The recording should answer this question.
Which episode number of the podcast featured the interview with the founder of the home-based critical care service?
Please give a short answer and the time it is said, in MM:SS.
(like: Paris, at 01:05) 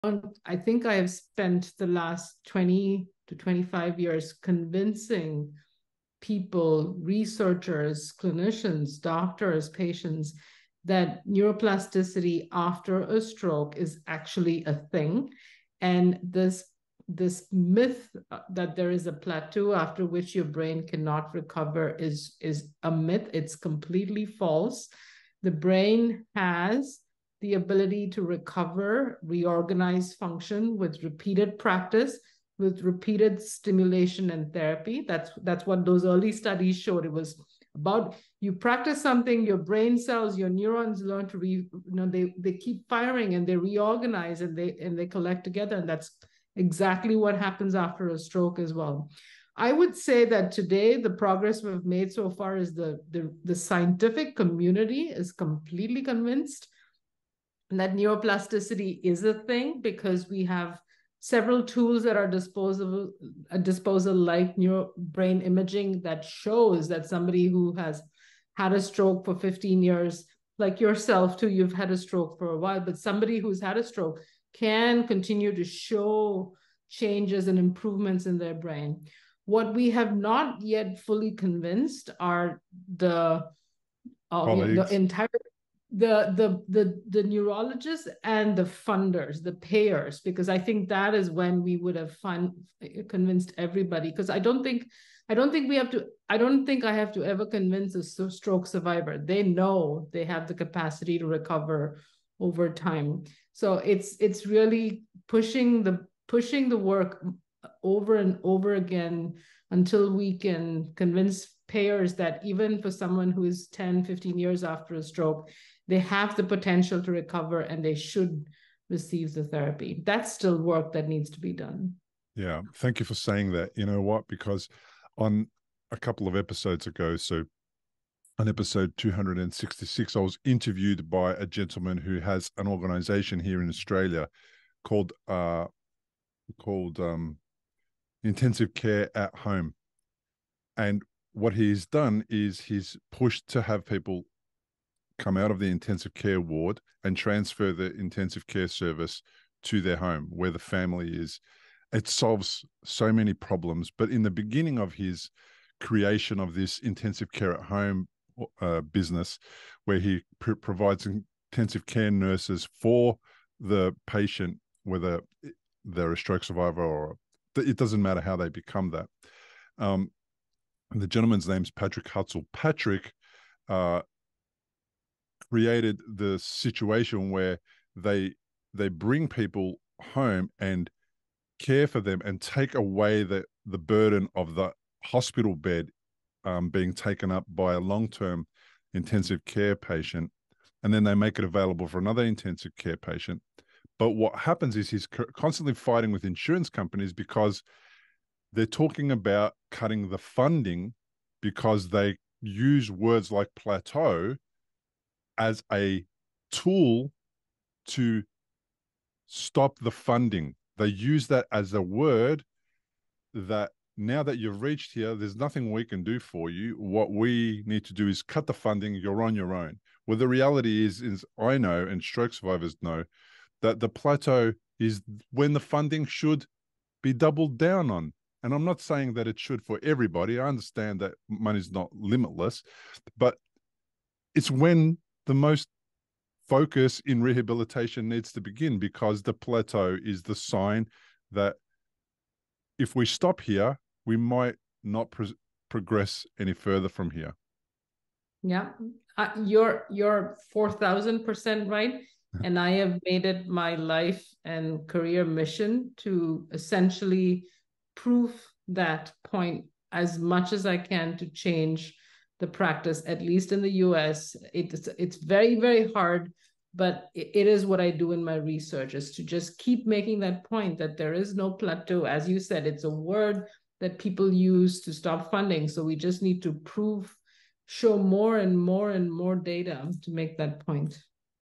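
266, at 02:08.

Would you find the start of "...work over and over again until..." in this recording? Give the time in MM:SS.
01:46.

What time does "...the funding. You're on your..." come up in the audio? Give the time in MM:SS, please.
03:38.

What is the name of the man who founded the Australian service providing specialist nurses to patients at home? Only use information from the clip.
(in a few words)
Patrick Hutzel.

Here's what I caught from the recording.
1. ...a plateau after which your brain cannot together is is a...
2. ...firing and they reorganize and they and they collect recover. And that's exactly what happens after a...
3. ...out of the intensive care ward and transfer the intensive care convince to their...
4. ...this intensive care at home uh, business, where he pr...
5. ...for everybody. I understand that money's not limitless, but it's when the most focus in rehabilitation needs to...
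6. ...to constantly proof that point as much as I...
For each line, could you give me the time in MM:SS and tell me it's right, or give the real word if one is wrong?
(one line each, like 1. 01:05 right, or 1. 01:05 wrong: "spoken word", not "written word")
1. 00:19 wrong: "recover", not "together"
2. 00:42 wrong: "together", not "recover"
3. 02:25 wrong: "service", not "convince"
4. 02:36 right
5. 03:49 right
6. 04:15 wrong: "essentially", not "constantly".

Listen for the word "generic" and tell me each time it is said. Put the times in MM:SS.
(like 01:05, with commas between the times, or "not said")
not said.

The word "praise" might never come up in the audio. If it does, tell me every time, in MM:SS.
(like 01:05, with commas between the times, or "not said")
not said.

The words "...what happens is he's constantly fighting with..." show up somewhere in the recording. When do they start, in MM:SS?
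03:14.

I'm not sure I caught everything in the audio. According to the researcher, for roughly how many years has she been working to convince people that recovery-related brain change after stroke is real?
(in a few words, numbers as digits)
20 to 25 years.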